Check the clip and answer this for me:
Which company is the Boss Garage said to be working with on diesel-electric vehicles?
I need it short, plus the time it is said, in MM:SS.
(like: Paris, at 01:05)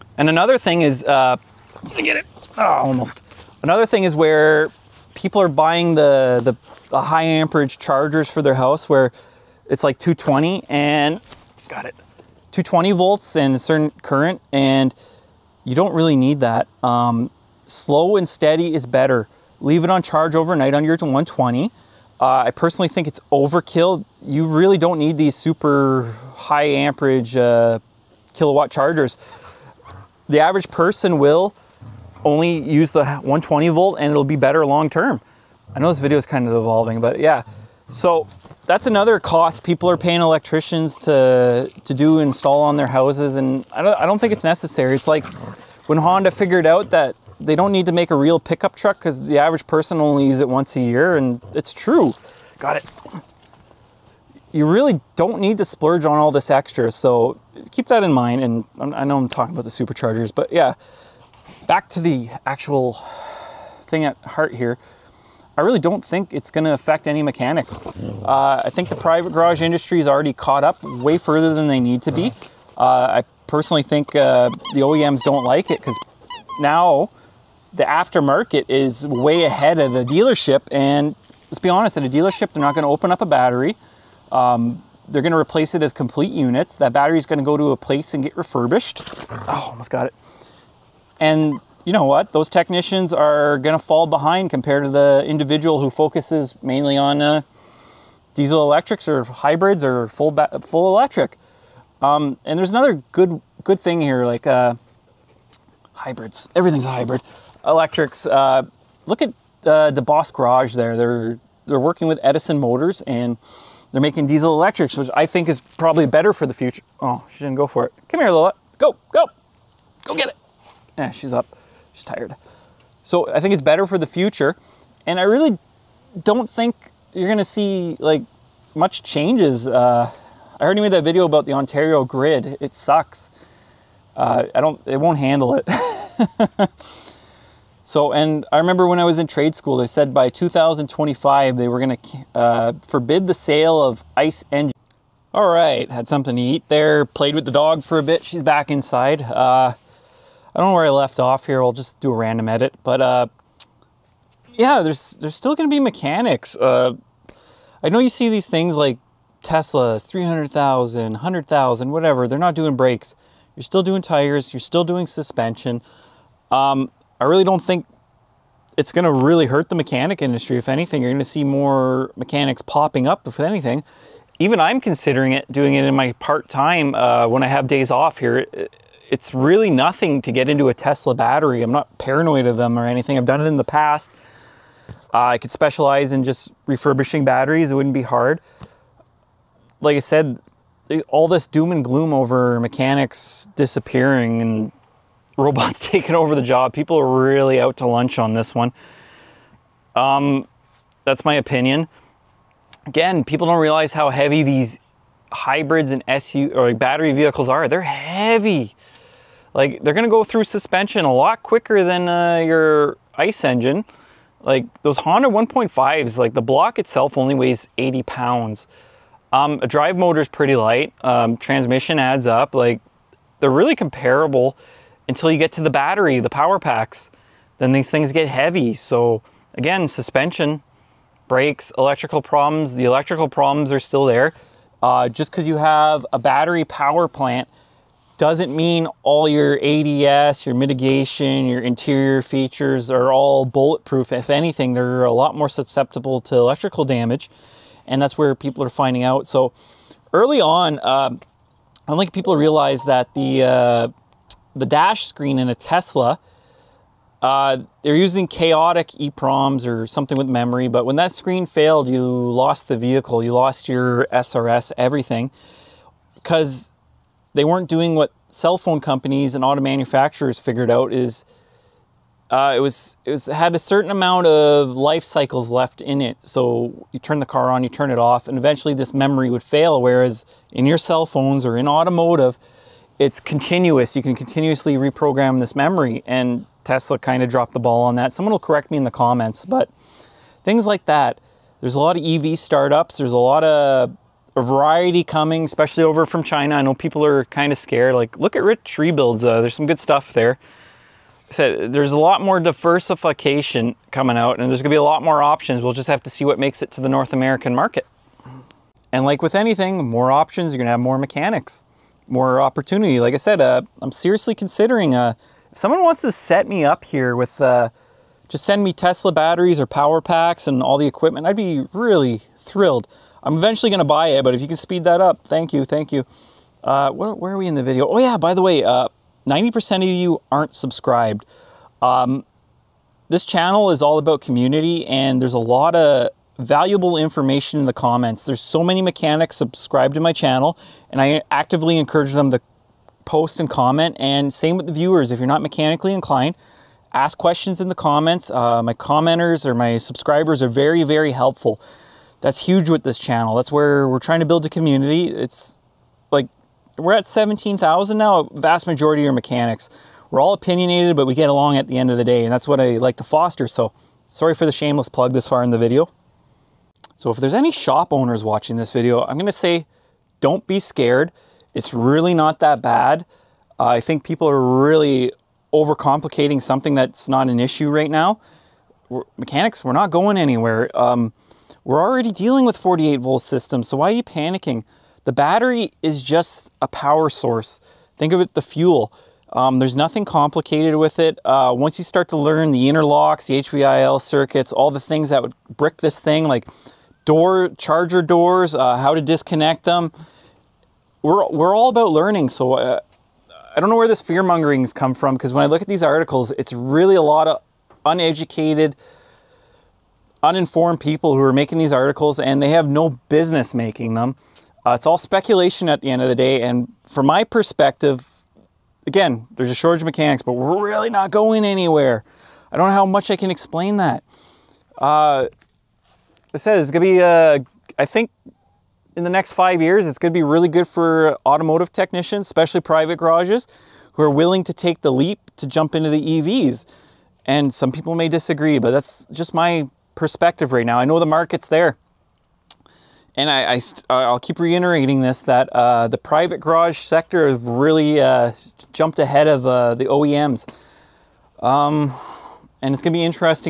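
Edison Motors, at 01:52.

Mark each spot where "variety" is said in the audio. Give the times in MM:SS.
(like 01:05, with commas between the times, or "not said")
04:54.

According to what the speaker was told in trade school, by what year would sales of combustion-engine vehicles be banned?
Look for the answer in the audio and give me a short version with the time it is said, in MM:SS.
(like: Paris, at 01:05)
2025, at 02:20.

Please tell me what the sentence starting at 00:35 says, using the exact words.
I know this video is kind of evolving, but yeah.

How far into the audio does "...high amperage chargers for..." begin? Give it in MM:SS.
00:07.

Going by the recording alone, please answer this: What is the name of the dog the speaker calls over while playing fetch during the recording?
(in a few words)
Lola.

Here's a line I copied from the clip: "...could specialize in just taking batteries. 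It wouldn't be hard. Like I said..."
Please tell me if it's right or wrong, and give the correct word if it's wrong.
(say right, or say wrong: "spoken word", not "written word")
wrong: "refurbishing", not "taking".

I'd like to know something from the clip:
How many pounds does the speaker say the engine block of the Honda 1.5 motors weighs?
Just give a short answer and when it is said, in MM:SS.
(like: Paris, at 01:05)
80 pounds, at 03:37.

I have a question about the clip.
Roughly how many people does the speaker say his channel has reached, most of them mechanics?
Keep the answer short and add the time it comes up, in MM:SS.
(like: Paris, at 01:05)
17,000, at 05:57.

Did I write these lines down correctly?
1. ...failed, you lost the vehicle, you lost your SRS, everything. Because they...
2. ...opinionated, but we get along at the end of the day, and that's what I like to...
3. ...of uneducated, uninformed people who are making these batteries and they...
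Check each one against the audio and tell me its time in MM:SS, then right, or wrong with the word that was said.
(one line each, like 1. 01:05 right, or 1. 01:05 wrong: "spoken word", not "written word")
1. 04:21 right
2. 06:00 right
3. 06:47 wrong: "articles", not "batteries".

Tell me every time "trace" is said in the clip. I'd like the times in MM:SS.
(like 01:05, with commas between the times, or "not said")
not said.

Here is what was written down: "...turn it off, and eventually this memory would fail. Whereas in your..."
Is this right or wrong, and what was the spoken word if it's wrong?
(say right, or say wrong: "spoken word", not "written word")
right.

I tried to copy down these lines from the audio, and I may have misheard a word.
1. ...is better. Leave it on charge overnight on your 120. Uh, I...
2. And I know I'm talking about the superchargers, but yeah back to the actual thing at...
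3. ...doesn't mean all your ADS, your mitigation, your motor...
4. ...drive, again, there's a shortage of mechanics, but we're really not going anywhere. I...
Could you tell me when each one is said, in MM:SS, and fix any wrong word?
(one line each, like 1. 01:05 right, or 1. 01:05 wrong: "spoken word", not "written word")
1. 00:18 right
2. 00:58 right
3. 03:58 wrong: "interior", not "motor"
4. 06:57 wrong: "perspective", not "drive".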